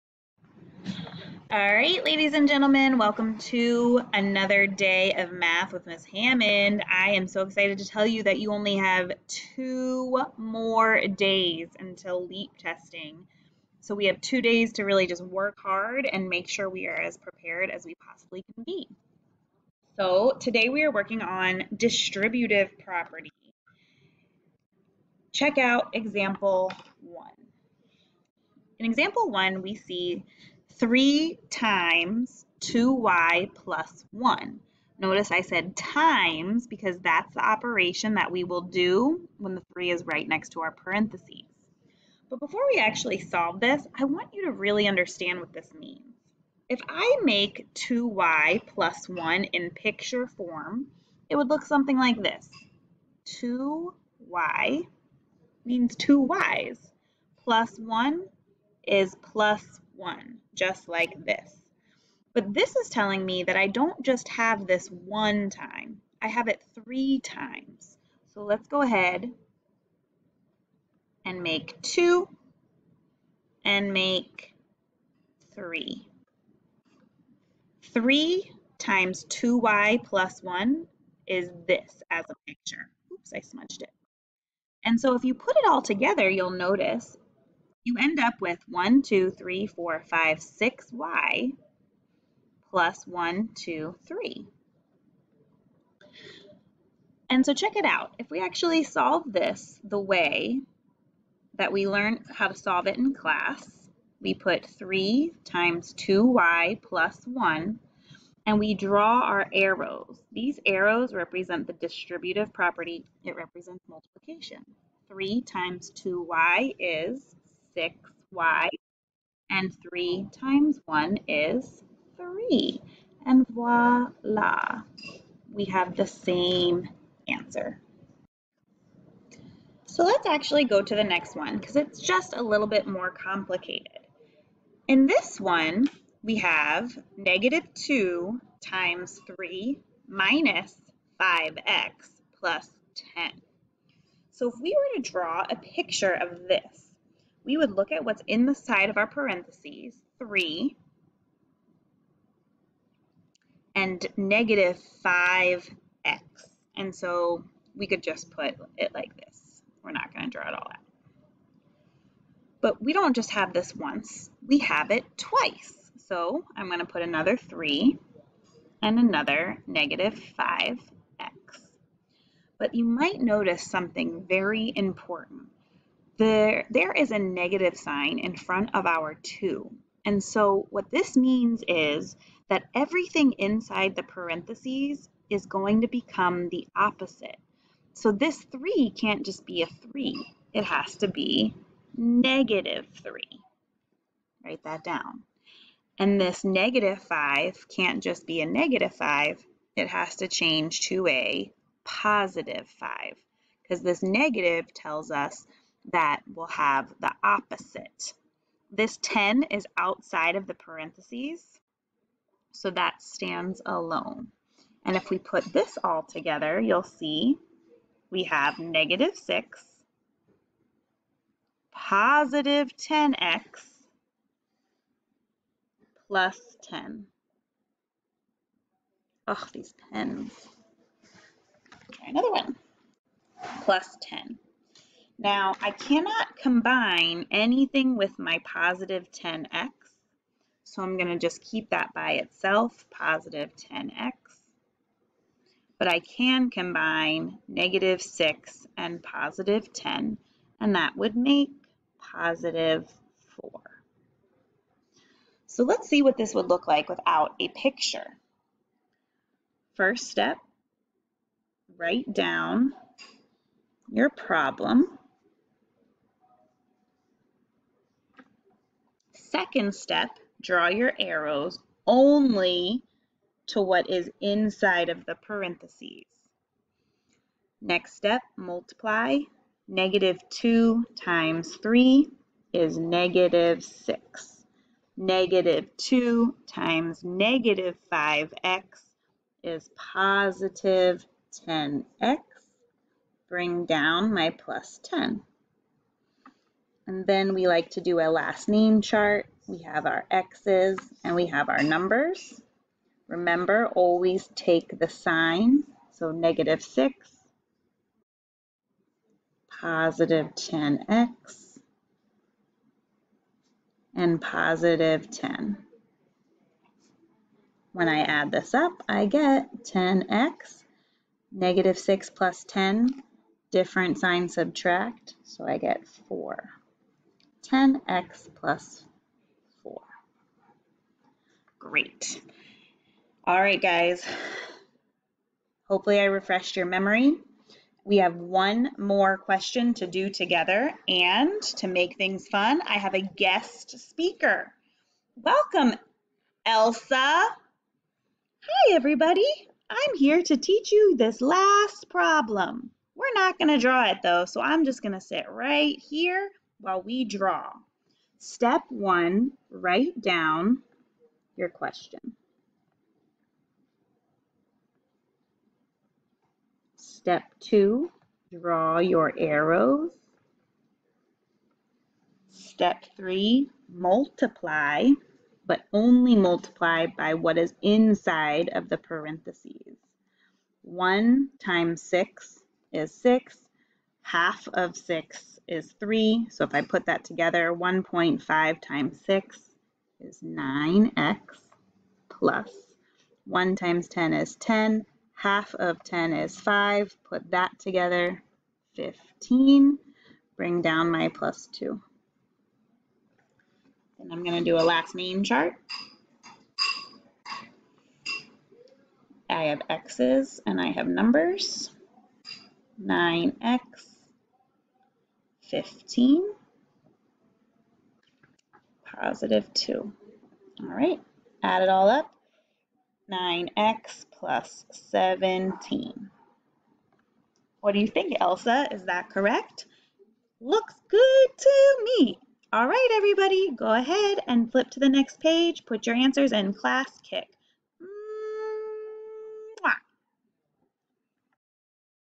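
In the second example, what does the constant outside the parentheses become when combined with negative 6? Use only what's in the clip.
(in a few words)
positive 4.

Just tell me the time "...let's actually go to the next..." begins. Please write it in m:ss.
2:10.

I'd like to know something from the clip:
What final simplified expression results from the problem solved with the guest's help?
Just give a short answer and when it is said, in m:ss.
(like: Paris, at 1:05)
9x + 17, at 7:03.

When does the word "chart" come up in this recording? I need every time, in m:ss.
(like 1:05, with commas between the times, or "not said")
4:58, 6:45.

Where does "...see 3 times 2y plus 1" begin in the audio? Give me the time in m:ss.
0:29.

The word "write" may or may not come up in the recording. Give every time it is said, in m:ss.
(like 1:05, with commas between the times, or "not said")
3:14, 4:21, 5:59.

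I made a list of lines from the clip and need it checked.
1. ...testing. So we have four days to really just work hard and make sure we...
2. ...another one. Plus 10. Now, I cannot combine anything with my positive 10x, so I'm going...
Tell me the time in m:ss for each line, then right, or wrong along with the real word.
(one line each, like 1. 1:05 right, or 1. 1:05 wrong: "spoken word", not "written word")
1. 0:12 wrong: "two", not "four"
2. 3:52 right.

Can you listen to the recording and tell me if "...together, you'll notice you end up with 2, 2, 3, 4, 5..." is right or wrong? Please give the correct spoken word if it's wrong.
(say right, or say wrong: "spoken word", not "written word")
wrong: "1", not "2".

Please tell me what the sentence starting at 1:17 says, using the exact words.
Three times 2y plus 1 is this as a picture.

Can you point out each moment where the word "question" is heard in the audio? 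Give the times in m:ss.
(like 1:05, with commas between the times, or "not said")
5:39, 6:01.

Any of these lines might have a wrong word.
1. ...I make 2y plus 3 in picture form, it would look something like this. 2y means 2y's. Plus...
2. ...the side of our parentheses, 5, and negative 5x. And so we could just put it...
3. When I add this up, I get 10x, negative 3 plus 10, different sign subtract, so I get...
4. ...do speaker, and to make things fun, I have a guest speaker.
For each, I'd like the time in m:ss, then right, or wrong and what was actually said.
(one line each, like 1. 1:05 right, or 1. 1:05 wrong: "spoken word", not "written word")
1. 0:46 wrong: "1", not "3"
2. 2:28 wrong: "3", not "5"
3. 5:17 wrong: "6", not "3"
4. 5:39 wrong: "together", not "speaker".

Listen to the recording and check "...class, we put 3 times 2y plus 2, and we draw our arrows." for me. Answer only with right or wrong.
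wrong.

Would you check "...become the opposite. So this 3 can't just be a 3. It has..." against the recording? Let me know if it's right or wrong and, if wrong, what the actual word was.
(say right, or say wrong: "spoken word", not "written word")
right.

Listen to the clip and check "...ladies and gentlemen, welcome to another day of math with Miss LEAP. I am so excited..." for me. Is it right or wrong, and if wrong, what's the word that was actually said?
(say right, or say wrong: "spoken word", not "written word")
wrong: "Hammond", not "LEAP".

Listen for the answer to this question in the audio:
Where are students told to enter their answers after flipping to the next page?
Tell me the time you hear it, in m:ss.
7:16.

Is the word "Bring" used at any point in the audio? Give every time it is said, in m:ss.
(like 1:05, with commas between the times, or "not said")
4:53, 6:40.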